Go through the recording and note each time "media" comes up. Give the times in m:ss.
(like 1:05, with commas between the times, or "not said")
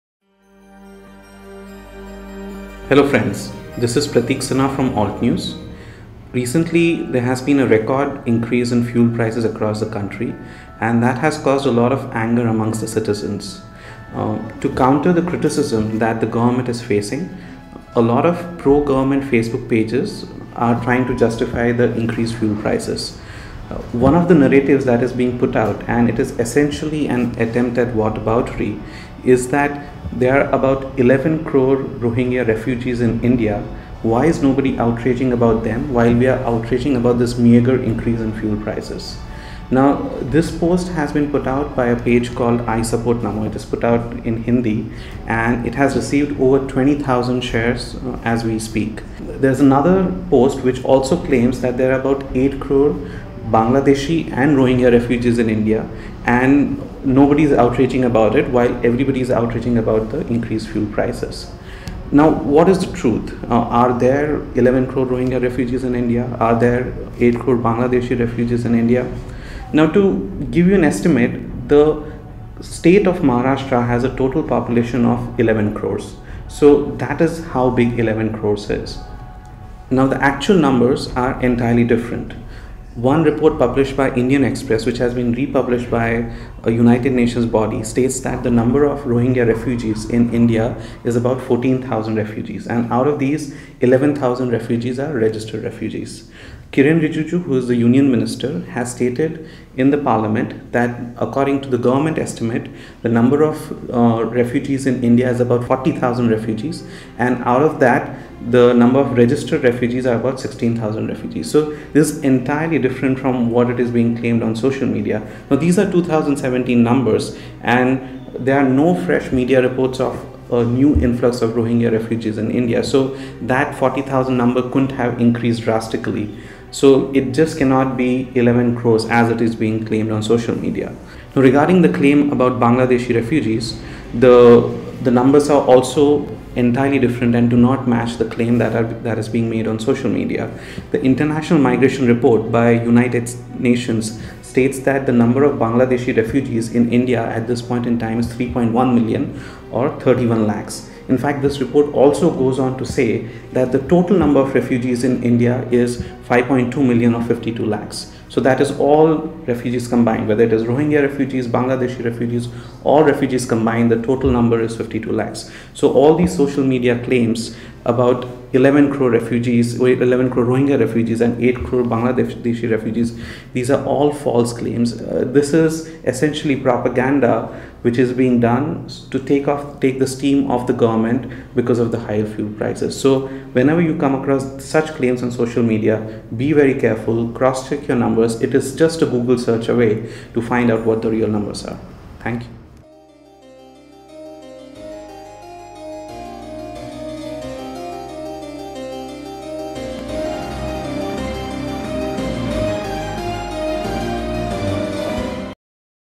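1:54, 1:59, 2:10, 2:20, 2:46, 3:05.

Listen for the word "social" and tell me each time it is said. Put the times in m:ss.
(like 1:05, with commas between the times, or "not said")
1:54, 2:10, 2:19, 2:46, 3:05.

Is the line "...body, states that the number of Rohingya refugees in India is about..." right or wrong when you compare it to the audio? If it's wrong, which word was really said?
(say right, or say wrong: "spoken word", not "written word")
right.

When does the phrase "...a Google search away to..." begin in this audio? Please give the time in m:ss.
3:09.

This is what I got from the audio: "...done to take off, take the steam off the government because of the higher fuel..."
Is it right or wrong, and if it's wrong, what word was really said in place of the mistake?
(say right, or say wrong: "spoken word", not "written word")
right.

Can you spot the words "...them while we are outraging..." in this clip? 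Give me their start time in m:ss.
0:35.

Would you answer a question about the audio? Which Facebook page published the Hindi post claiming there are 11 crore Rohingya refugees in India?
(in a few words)
I Support Namo.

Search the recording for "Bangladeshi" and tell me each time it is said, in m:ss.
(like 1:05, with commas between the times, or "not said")
0:53, 1:07, 2:12, 2:25, 2:41, 2:51.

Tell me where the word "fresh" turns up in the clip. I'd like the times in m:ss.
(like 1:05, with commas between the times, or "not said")
1:59.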